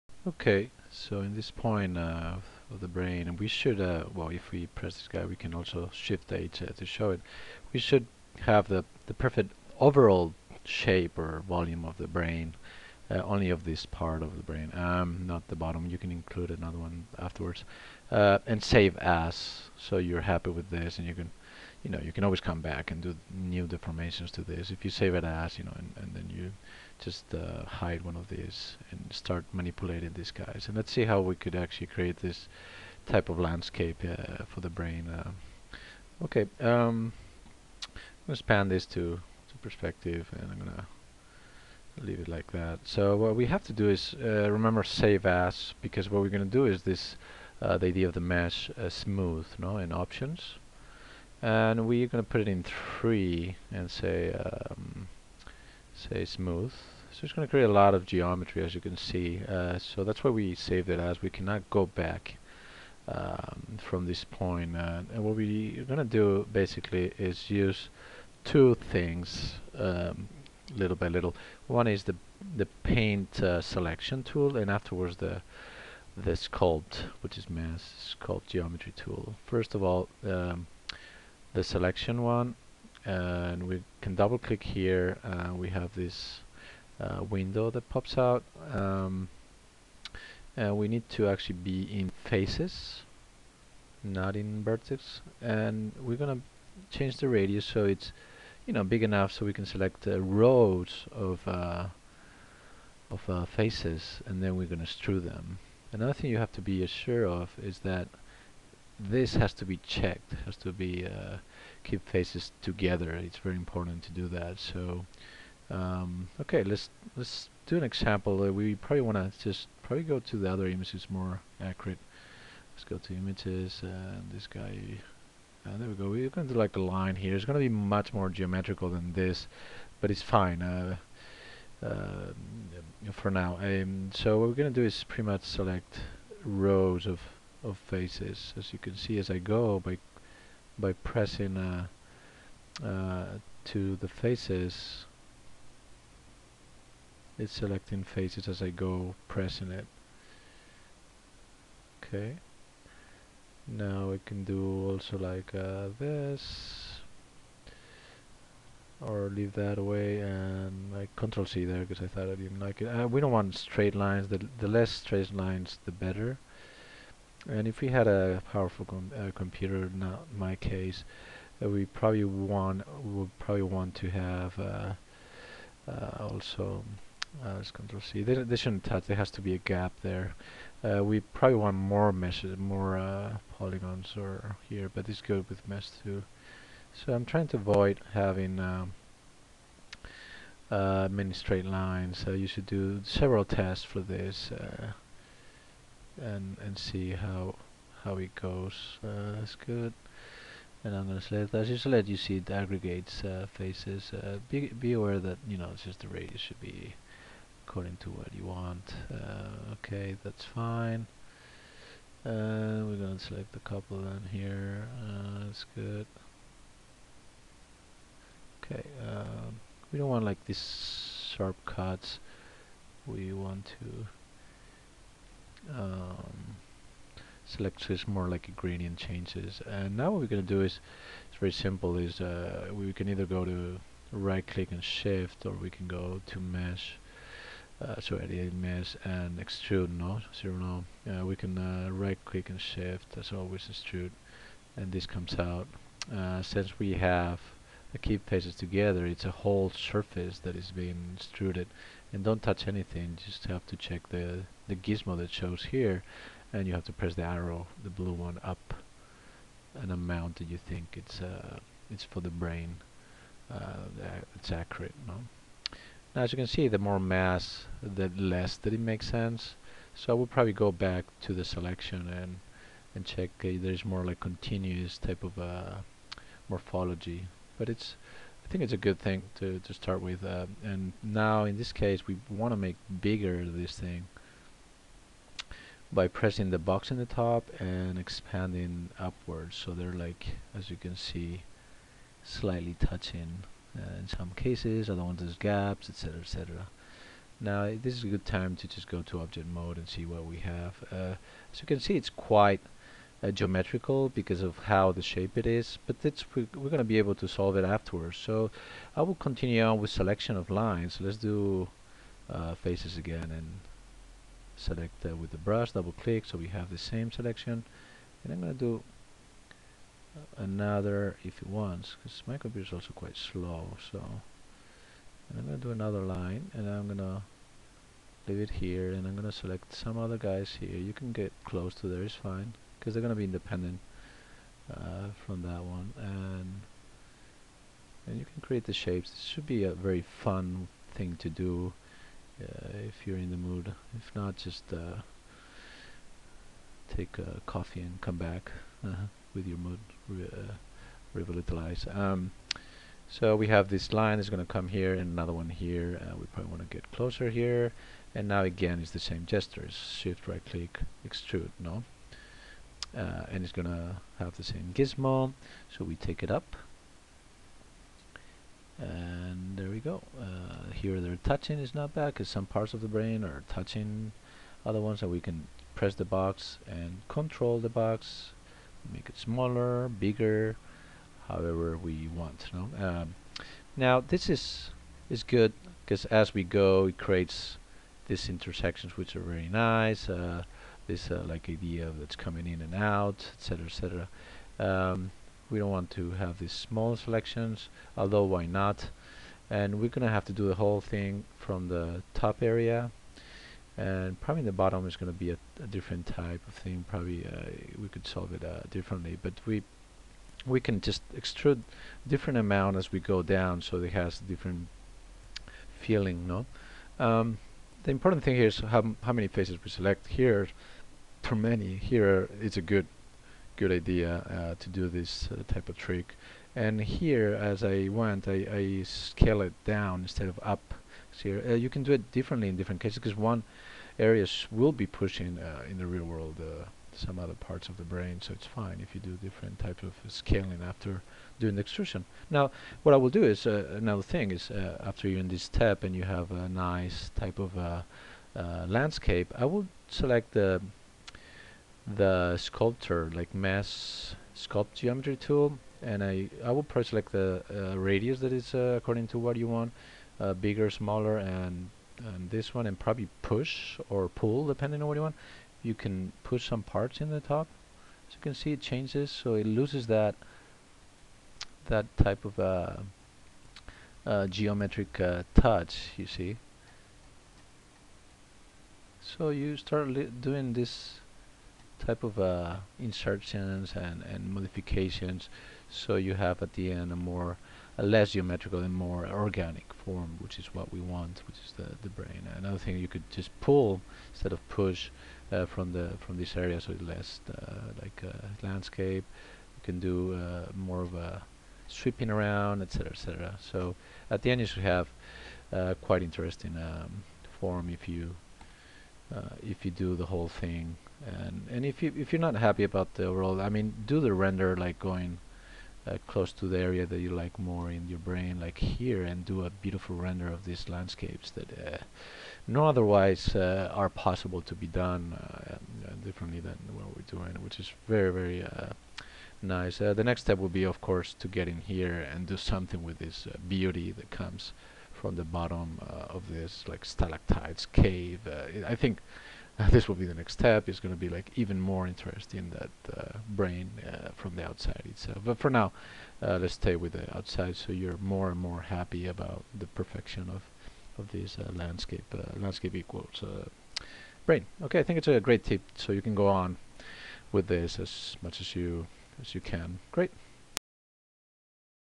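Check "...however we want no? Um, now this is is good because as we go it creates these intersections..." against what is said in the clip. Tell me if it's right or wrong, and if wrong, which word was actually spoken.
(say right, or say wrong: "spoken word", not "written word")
right.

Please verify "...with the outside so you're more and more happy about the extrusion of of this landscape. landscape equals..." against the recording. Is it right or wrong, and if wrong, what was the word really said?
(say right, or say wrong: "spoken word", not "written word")
wrong: "perfection", not "extrusion".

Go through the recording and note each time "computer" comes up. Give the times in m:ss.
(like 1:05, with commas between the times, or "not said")
2:49, 5:22.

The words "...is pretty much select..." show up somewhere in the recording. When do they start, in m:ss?
2:14.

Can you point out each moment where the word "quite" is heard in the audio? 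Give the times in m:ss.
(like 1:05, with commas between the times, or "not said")
5:02, 5:22, 8:25.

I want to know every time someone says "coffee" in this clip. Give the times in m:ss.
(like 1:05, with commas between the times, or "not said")
5:47.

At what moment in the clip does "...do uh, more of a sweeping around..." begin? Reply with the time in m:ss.
8:19.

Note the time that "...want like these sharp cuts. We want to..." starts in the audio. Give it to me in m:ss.
3:40.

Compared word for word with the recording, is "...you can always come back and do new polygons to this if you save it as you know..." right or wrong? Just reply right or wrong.
wrong.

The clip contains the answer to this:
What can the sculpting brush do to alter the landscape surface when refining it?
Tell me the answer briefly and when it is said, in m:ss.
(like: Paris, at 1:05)
push or pull, at 7:43.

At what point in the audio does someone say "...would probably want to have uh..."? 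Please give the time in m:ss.
2:53.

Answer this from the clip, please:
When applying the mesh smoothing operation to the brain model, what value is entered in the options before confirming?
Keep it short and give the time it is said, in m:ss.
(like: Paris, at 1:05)
3, at 0:52.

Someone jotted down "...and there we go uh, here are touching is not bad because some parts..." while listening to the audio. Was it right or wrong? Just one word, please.
right.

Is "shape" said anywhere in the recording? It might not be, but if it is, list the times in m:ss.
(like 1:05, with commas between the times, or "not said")
0:10, 5:05, 5:38.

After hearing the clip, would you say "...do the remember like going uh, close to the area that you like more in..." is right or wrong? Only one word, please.
wrong.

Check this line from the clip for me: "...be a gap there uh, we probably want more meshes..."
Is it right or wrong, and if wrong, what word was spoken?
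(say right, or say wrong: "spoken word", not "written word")
right.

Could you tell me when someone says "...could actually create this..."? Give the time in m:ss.
0:31.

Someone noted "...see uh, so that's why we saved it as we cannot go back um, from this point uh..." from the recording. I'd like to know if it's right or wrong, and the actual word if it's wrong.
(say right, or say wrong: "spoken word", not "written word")
right.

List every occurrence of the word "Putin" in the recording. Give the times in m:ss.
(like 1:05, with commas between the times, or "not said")
not said.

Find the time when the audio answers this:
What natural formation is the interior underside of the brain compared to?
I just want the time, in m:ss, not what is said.
8:56.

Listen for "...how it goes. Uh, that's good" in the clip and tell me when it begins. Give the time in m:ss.
3:18.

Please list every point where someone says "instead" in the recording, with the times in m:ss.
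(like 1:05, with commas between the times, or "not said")
7:10, 8:14.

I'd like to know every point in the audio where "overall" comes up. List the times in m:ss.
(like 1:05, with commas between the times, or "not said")
0:09, 8:33.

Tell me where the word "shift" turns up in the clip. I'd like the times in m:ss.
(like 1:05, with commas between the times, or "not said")
0:05, 3:54, 4:02, 5:59.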